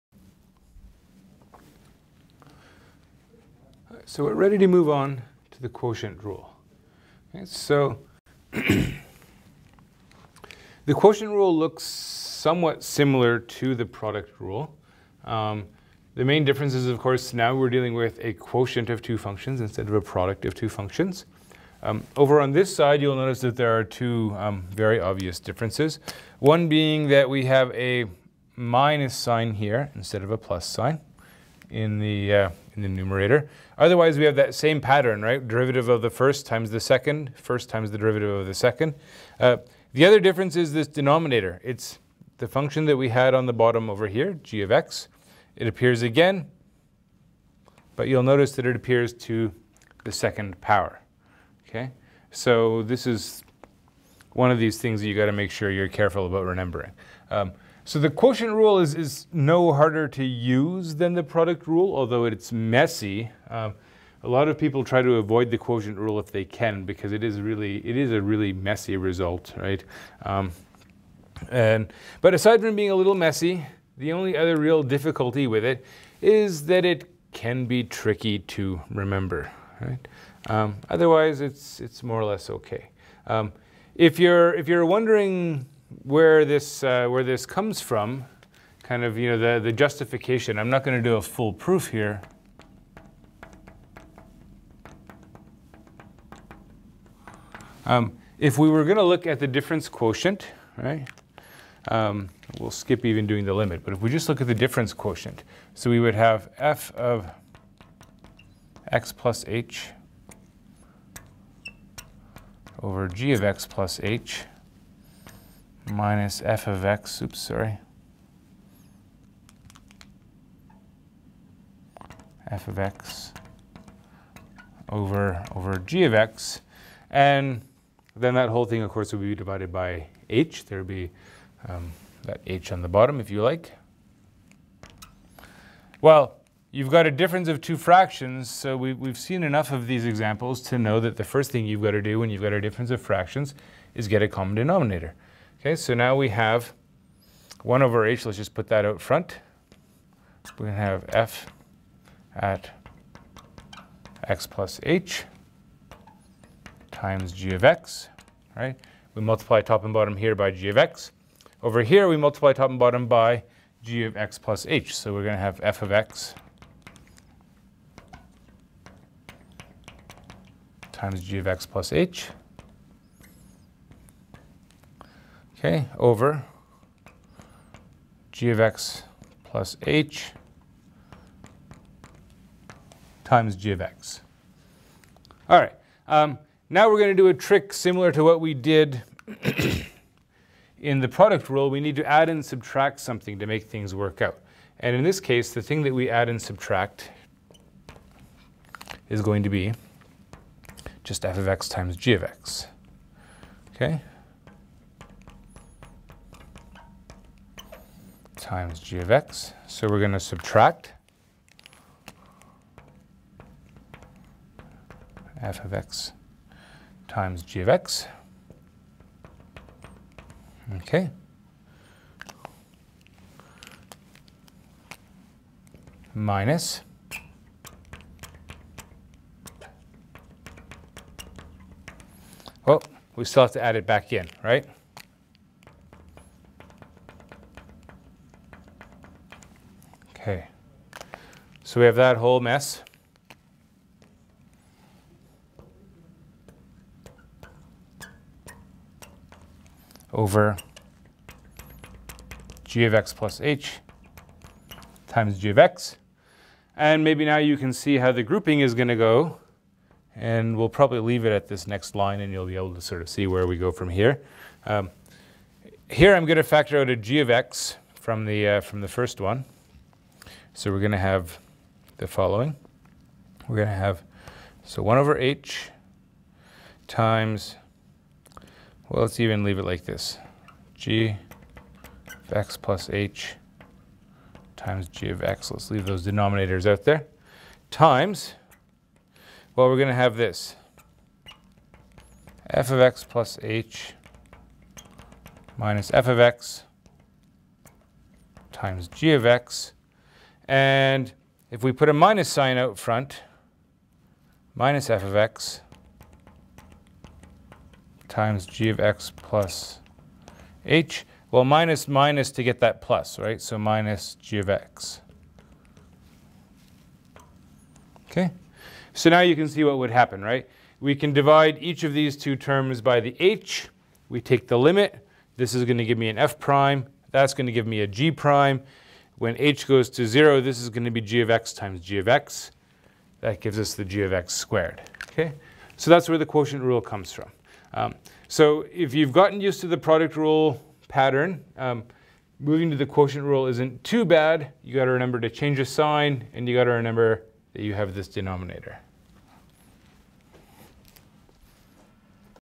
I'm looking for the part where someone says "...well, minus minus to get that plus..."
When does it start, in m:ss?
5:11.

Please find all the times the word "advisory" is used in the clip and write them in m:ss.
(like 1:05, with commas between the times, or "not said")
not said.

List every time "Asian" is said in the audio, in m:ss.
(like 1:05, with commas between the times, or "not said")
not said.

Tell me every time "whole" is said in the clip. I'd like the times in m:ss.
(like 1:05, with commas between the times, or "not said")
2:08, 4:02.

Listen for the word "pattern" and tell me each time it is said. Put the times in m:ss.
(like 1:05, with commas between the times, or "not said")
0:34, 5:40.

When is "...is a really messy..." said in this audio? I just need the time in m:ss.
1:07.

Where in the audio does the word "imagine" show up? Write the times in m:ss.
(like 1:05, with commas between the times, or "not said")
not said.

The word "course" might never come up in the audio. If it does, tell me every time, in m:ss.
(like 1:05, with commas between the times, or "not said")
0:16, 2:08.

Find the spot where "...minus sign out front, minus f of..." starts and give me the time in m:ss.
5:01.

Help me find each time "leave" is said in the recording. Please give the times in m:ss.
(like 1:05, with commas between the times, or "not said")
4:20, 4:39, 4:45.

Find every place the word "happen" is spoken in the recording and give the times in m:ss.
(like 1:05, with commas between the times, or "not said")
5:19.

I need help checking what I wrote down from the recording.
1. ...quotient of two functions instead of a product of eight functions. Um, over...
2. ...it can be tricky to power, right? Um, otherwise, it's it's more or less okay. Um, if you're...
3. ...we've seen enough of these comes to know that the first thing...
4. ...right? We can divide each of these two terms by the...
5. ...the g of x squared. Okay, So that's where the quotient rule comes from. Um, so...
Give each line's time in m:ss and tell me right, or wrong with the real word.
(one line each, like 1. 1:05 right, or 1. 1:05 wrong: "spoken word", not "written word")
1. 0:18 wrong: "two", not "eight"
2. 1:16 wrong: "remember", not "power"
3. 2:18 wrong: "examples", not "comes"
4. 5:20 right
5. 5:33 right.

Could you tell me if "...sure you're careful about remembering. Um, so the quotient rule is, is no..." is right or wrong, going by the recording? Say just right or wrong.
right.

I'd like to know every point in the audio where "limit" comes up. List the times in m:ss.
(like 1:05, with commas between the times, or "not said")
1:43, 5:24.